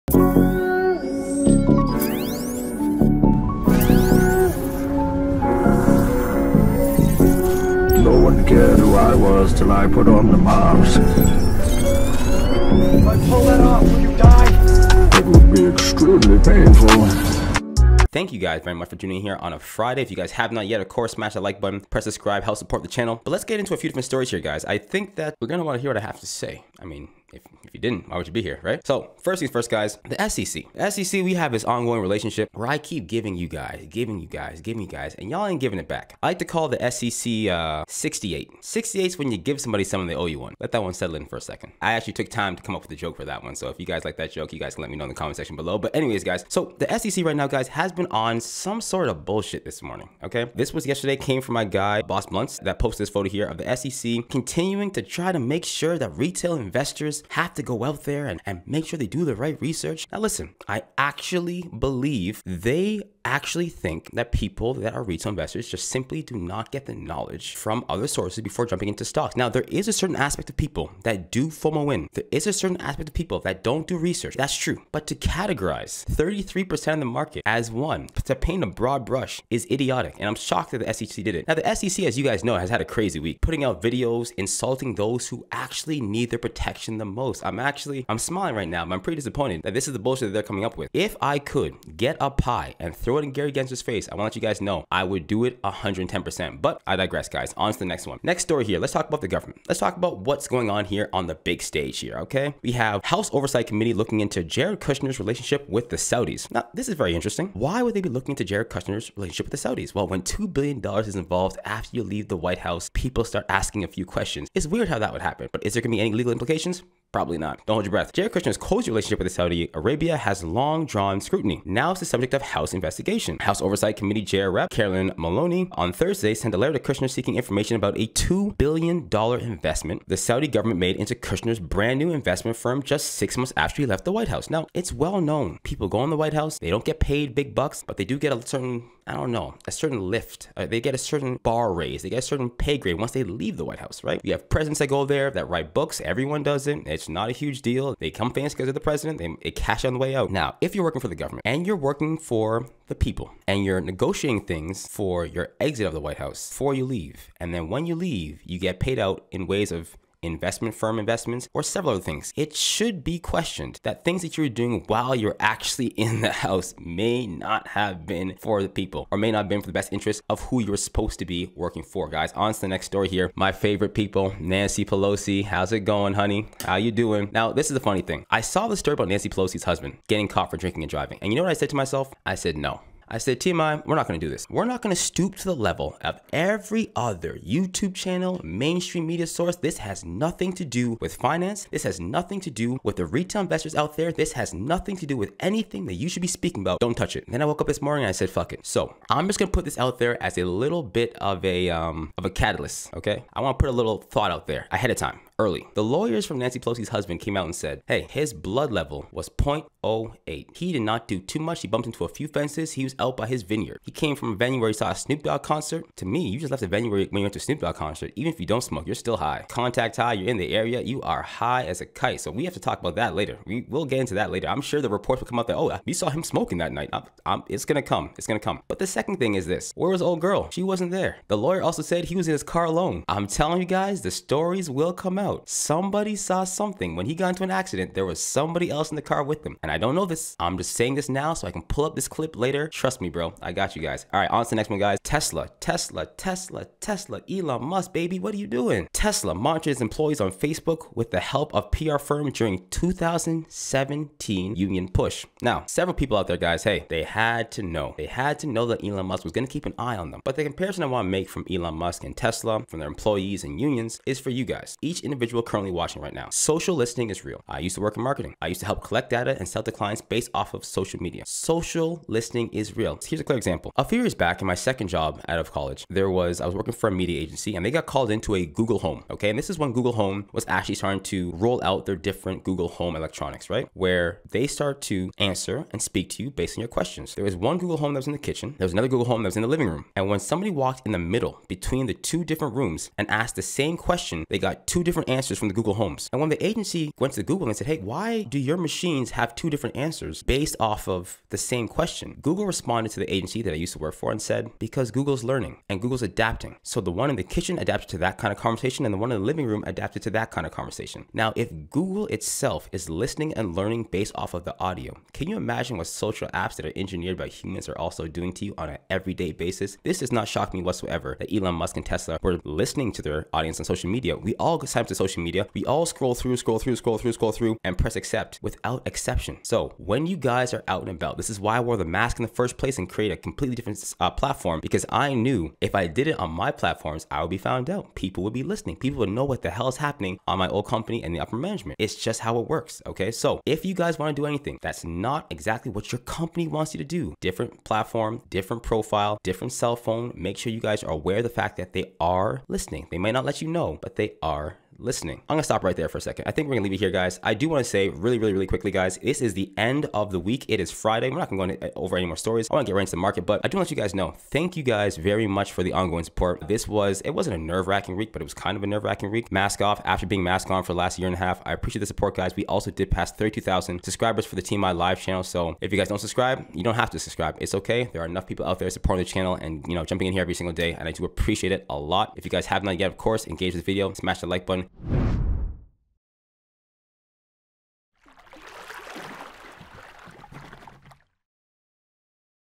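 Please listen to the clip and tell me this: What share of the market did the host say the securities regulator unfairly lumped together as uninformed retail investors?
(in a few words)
33%.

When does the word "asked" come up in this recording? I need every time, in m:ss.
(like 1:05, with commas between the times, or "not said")
4:53.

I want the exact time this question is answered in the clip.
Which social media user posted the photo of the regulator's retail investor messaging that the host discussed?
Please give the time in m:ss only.
0:52.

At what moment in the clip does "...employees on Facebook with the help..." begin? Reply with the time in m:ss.
4:09.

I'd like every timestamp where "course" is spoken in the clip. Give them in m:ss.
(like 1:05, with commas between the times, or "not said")
0:20, 6:22.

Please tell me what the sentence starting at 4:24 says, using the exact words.
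Each individual currently watching right now.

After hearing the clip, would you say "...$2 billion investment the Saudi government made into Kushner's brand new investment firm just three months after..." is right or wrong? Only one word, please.
wrong.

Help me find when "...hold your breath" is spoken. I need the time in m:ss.
1:57.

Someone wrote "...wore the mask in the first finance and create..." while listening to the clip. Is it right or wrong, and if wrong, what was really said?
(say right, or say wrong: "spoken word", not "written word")
wrong: "place", not "finance".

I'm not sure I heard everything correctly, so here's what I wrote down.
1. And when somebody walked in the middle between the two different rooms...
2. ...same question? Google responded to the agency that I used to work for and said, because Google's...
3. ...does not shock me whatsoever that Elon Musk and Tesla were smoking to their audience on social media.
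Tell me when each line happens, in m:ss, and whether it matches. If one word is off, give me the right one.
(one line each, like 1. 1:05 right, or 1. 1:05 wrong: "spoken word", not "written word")
1. 4:49 right
2. 5:01 right
3. 5:19 wrong: "listening", not "smoking".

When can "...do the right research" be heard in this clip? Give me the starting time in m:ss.
0:59.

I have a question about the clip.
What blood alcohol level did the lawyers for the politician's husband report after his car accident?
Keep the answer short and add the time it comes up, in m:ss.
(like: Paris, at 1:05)
0.08, at 3:29.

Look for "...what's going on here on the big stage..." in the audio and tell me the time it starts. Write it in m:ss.
1:40.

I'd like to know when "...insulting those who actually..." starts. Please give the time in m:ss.
1:24.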